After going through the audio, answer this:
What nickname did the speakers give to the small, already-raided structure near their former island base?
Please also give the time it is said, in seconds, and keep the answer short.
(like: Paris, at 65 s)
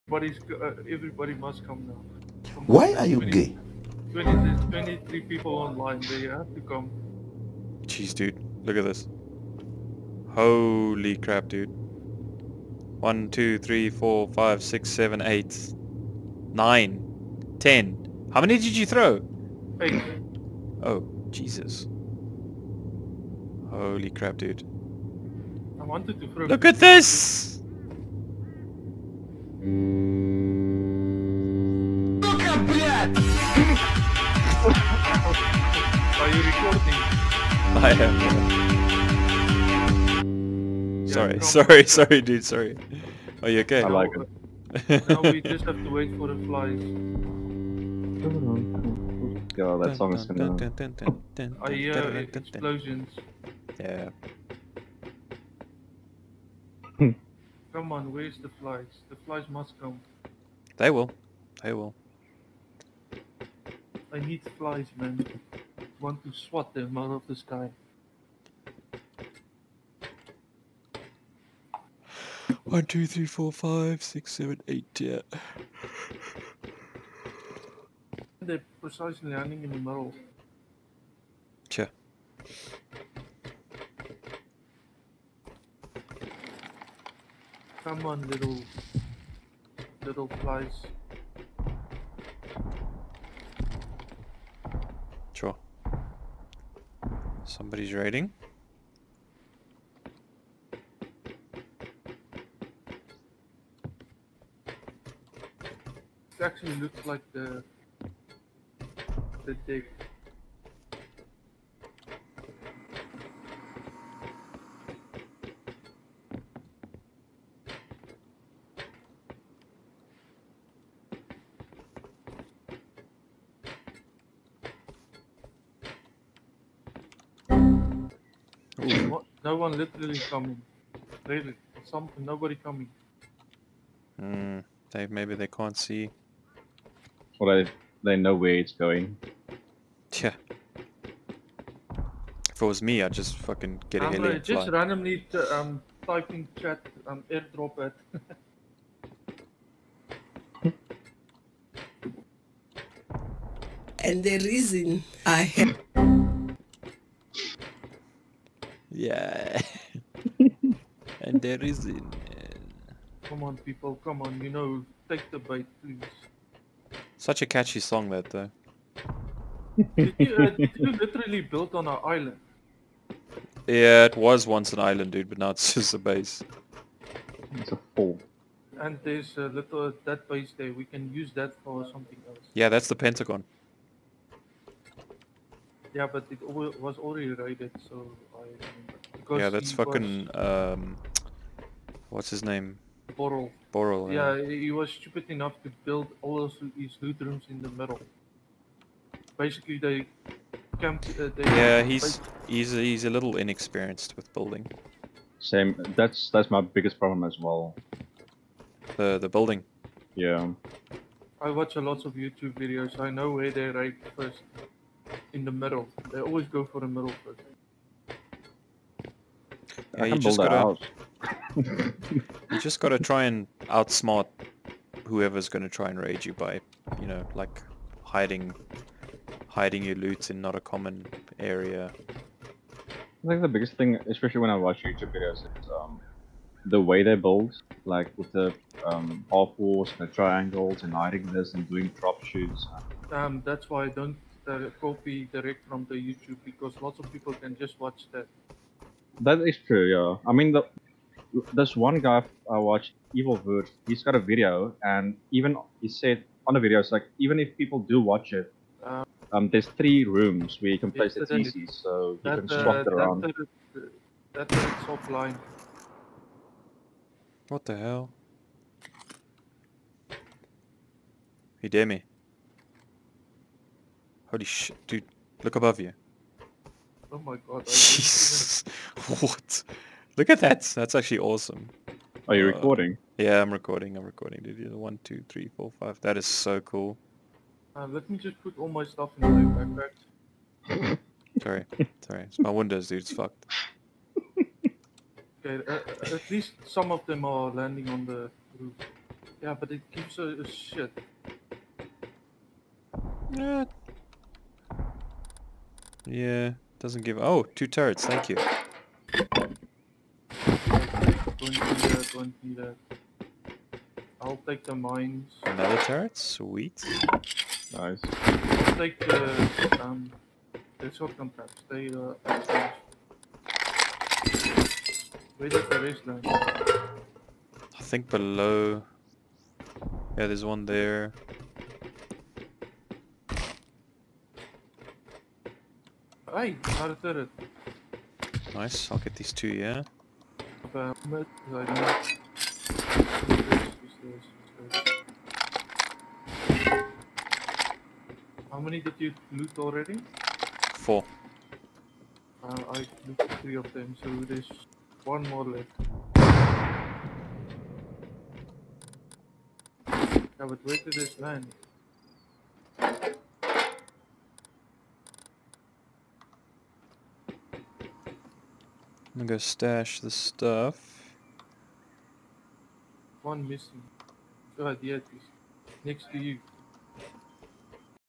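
the Pentagon, at 182 s.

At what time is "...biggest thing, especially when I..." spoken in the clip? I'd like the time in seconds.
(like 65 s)
233 s.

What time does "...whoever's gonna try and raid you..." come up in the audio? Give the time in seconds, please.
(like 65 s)
225 s.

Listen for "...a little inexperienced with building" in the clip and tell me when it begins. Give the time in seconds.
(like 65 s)
203 s.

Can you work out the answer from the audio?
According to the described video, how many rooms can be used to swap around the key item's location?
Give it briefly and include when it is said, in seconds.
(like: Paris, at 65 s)
3, at 259 s.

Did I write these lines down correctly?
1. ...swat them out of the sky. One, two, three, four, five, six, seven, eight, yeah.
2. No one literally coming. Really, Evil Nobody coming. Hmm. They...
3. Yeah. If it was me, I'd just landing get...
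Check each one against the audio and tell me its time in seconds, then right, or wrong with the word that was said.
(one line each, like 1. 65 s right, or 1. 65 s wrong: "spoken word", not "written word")
1. 66 s right
2. 129 s wrong: "Some", not "Evil"
3. 140 s wrong: "fucking", not "landing".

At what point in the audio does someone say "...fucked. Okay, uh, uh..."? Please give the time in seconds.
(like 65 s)
293 s.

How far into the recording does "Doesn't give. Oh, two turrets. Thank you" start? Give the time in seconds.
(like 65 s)
306 s.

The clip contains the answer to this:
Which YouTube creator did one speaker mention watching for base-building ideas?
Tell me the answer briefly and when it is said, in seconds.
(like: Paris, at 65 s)
Evil Wurst, at 253 s.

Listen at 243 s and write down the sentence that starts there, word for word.
Um, that's why I don't uh, copy direct from the YouTube because lots of people can just watch that.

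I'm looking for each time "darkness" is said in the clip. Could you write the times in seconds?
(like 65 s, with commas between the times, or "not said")
not said.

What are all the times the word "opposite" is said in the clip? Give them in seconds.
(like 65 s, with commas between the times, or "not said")
not said.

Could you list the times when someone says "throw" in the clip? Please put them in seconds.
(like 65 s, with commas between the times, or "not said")
18 s, 26 s.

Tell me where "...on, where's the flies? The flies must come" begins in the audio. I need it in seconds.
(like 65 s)
57 s.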